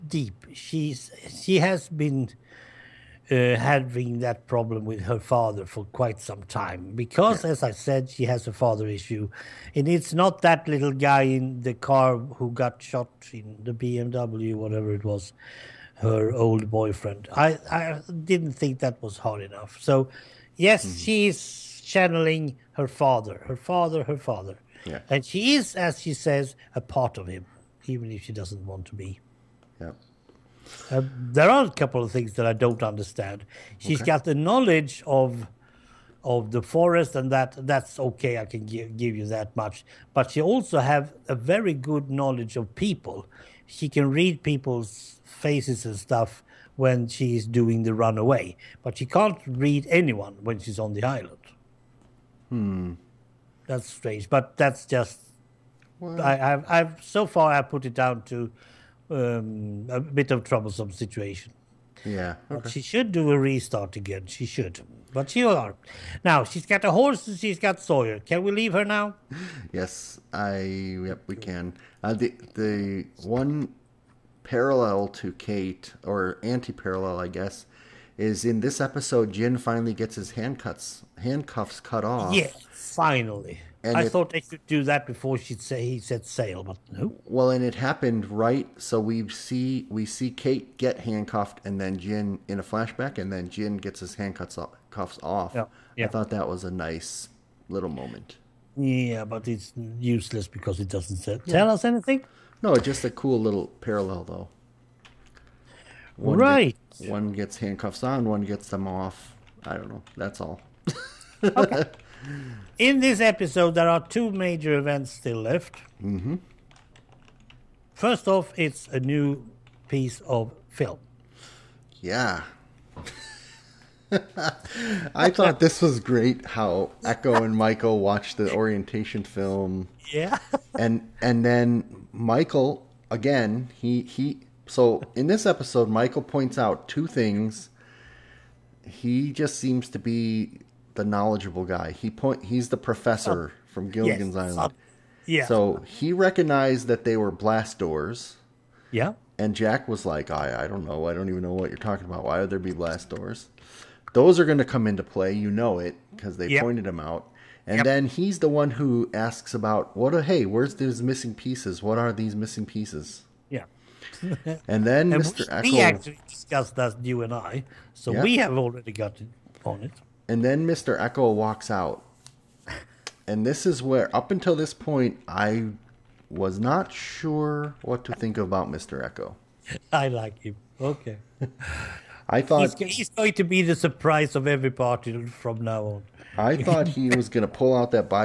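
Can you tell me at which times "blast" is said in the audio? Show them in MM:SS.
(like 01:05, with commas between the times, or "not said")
02:27, 02:32.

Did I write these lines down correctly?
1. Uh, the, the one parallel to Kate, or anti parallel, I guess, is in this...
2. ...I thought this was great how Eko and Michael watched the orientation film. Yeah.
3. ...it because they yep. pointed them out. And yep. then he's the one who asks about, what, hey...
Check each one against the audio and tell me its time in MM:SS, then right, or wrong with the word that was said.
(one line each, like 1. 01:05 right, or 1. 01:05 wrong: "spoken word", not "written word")
1. 01:12 right
2. 02:05 right
3. 02:35 right.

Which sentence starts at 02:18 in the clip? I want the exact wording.
He just seems to be the knowledgeable guy.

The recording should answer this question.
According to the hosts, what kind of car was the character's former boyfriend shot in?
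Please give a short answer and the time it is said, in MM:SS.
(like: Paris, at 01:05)
BMW, at 00:13.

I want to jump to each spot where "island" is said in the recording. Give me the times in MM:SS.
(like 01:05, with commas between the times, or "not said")
00:51, 02:24.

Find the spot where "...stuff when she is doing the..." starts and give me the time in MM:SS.
00:45.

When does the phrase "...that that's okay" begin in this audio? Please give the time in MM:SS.
00:37.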